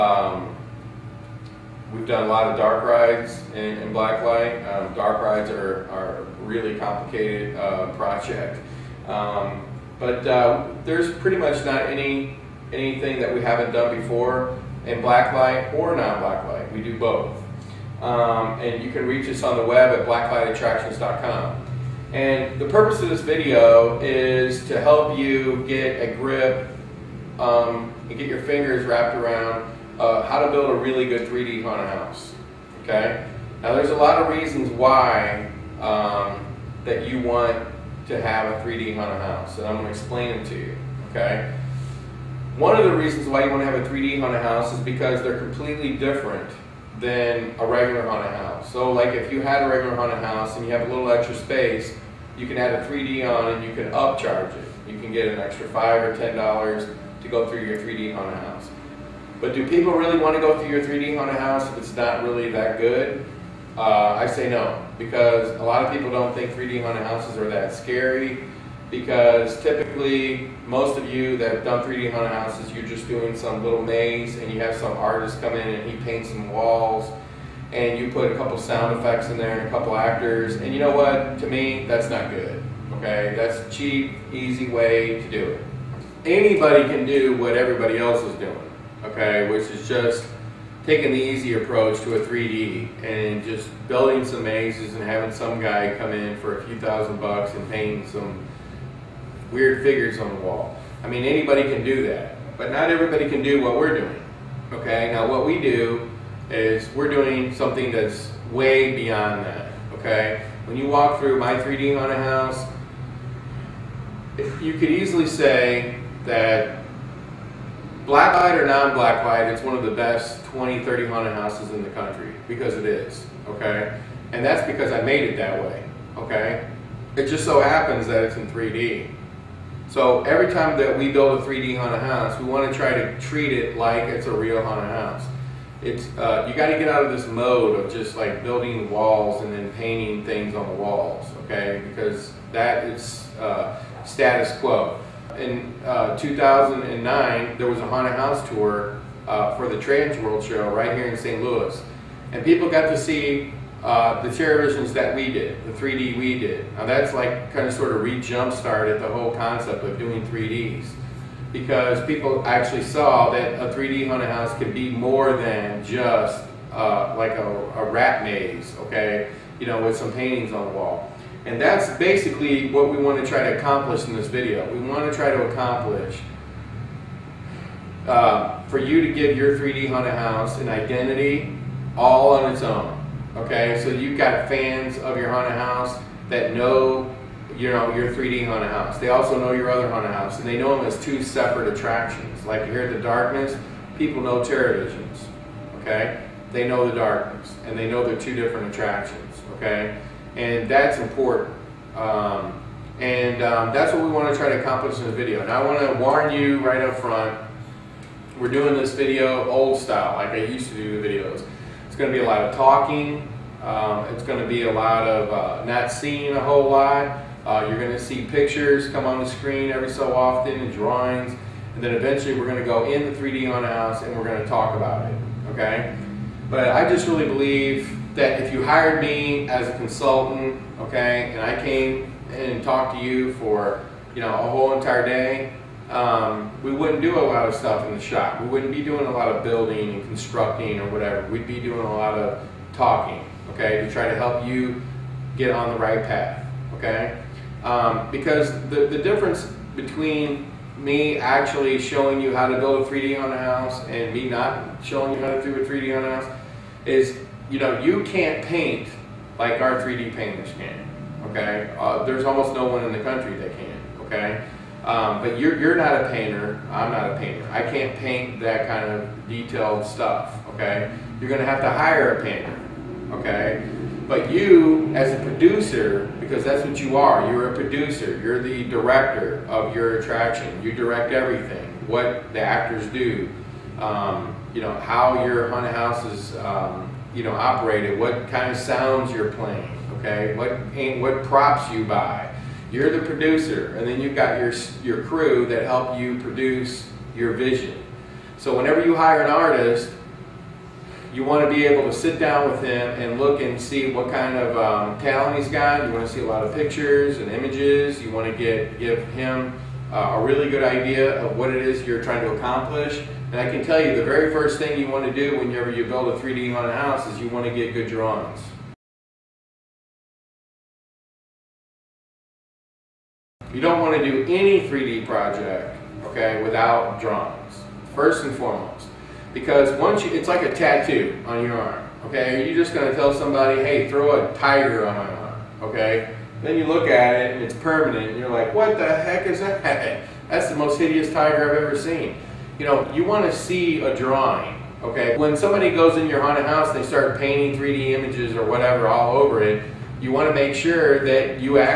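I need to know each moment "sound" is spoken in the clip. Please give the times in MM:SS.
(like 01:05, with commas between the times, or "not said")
01:18, 04:48.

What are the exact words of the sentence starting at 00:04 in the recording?
Um, dark rides are, are really complicated uh, project.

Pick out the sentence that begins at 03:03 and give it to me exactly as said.
Okay, so you've got fans of your haunted house that know, you know, your 3D haunted house.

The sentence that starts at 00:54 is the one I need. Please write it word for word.
You can get an extra five or ten dollars to go through your 3D haunted house.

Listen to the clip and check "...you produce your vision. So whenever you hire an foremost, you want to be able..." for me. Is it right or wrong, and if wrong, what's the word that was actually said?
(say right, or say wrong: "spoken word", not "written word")
wrong: "artist", not "foremost".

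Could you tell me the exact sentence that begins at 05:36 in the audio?
Then you look at it and it's permanent and you're like, what the heck is that?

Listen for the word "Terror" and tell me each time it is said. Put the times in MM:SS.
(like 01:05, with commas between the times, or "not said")
02:34, 03:14.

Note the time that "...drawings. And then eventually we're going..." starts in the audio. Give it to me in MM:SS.
03:40.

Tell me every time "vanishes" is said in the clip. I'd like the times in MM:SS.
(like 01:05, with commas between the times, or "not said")
not said.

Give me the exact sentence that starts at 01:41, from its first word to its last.
I mean, anybody can do that, but not everybody can do what we're doing.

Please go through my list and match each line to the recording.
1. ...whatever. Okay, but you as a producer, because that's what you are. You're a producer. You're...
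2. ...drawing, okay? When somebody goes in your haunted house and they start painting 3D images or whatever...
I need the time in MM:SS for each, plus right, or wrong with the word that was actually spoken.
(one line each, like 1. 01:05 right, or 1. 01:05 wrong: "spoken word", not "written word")
1. 04:32 wrong: "painter", not "whatever"
2. 05:43 right.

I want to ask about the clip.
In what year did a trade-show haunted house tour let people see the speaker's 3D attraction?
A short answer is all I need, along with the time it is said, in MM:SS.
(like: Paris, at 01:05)
2009, at 02:26.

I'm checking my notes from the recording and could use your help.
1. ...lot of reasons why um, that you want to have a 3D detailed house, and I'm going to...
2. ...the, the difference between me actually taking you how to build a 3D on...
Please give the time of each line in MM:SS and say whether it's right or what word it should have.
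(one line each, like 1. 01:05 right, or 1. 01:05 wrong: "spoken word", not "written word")
1. 00:33 wrong: "haunted", not "detailed"
2. 04:08 wrong: "showing", not "taking".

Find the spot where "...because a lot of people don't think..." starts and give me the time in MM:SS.
01:04.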